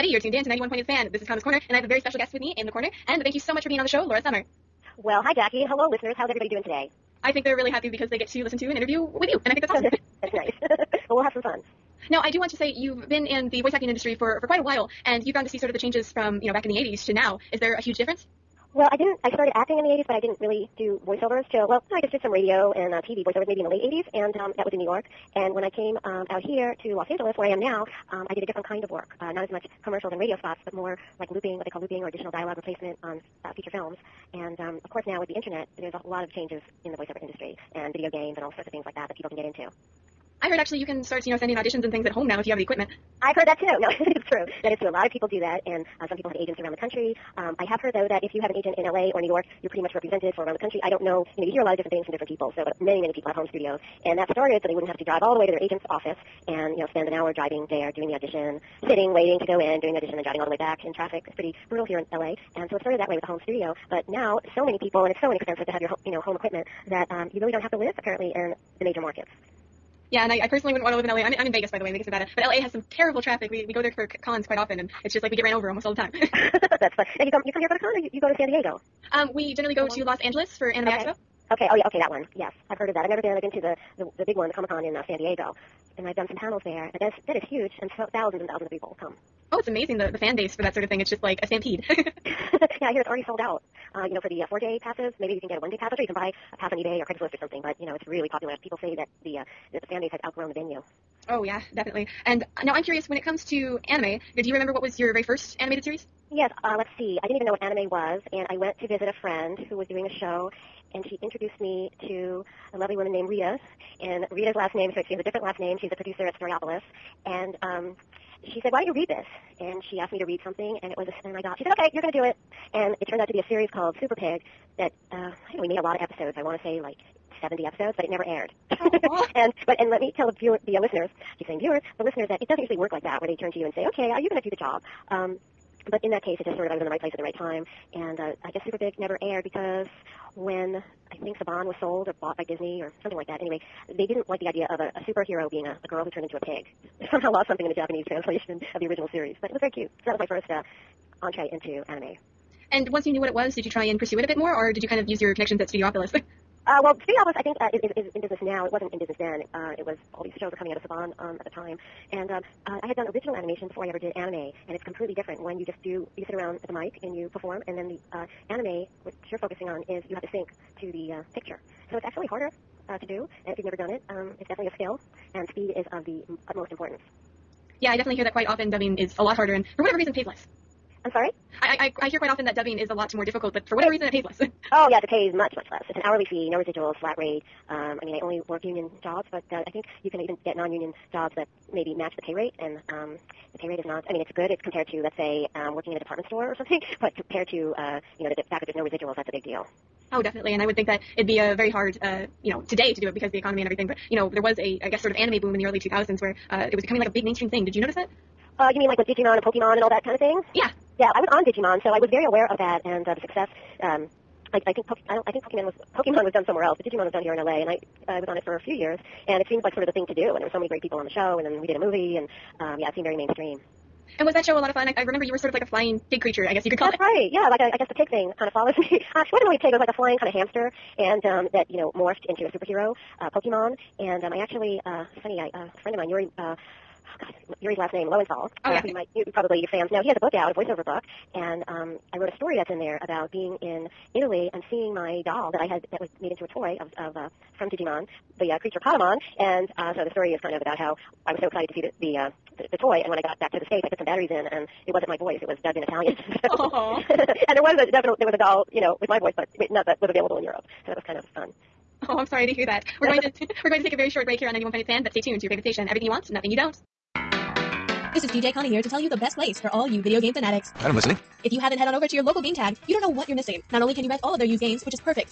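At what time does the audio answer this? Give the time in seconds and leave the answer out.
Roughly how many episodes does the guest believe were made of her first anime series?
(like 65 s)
127 s.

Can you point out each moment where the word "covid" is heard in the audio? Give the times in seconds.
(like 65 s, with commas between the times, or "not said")
not said.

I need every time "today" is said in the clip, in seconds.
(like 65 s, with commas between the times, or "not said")
6 s, 202 s.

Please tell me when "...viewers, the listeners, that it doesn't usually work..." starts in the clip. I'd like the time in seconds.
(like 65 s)
131 s.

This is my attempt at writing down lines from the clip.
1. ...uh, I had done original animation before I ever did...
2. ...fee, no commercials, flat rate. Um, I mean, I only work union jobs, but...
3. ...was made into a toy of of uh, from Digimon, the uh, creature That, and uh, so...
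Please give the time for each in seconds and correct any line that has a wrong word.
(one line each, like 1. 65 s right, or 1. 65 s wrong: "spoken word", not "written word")
1. 162 s right
2. 186 s wrong: "residuals", not "commercials"
3. 245 s wrong: "Patamon", not "That".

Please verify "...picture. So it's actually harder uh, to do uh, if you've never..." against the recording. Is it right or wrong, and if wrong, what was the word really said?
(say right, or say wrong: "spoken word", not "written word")
right.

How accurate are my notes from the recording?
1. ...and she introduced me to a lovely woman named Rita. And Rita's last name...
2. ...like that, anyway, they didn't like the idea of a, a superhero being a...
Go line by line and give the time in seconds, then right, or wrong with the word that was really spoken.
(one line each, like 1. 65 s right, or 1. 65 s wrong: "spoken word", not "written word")
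1. 110 s right
2. 143 s right.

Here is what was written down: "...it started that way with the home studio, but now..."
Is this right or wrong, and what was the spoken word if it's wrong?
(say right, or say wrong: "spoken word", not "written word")
right.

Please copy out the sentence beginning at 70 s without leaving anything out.
Yeah, and I, I personally wouldn't want to live in LA.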